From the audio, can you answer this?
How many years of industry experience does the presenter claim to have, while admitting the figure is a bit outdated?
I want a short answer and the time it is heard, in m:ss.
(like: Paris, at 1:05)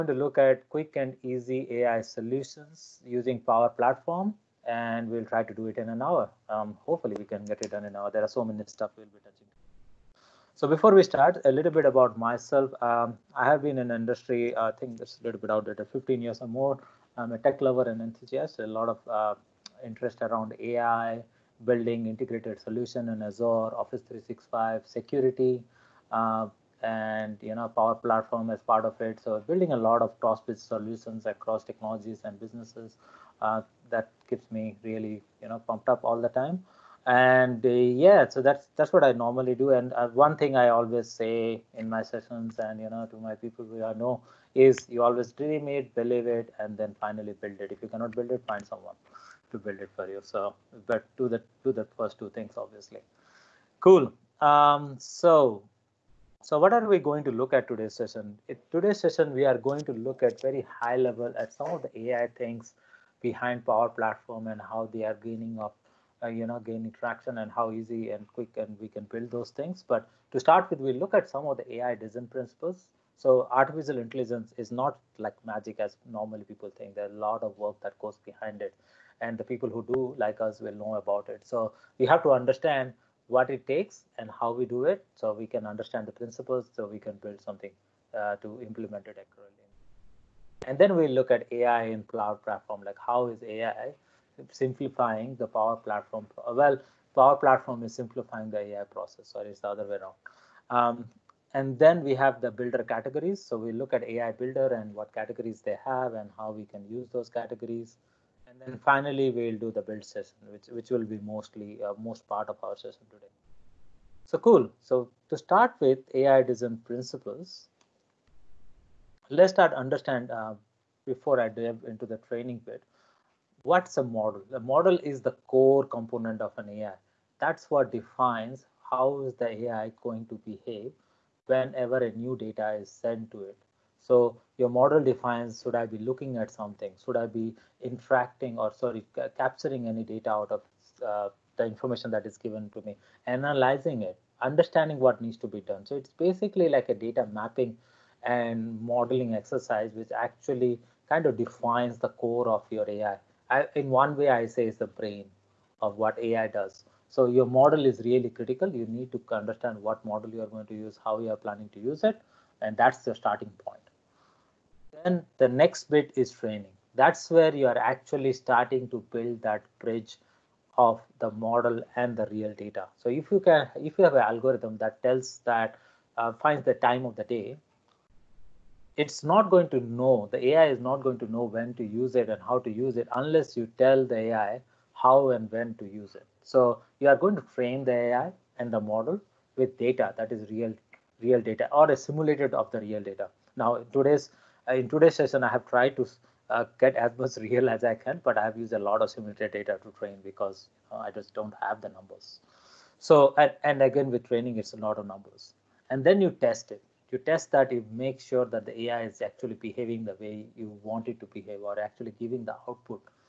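15, at 0:15.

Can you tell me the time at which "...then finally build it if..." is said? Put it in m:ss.
0:46.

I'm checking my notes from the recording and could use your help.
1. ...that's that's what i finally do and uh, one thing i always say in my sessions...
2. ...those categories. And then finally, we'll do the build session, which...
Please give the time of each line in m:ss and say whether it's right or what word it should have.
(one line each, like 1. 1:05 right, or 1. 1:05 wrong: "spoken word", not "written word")
1. 0:38 wrong: "normally", not "finally"
2. 1:47 right.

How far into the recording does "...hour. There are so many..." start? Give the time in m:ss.
0:07.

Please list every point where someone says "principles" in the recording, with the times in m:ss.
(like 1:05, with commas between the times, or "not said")
1:12, 1:26, 1:56.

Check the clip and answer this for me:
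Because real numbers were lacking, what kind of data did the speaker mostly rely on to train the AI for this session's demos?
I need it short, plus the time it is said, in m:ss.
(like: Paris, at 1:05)
simulated data, at 3:19.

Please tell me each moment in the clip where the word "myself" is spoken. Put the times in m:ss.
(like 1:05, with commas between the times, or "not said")
0:12.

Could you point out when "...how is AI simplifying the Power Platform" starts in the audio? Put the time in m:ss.
1:33.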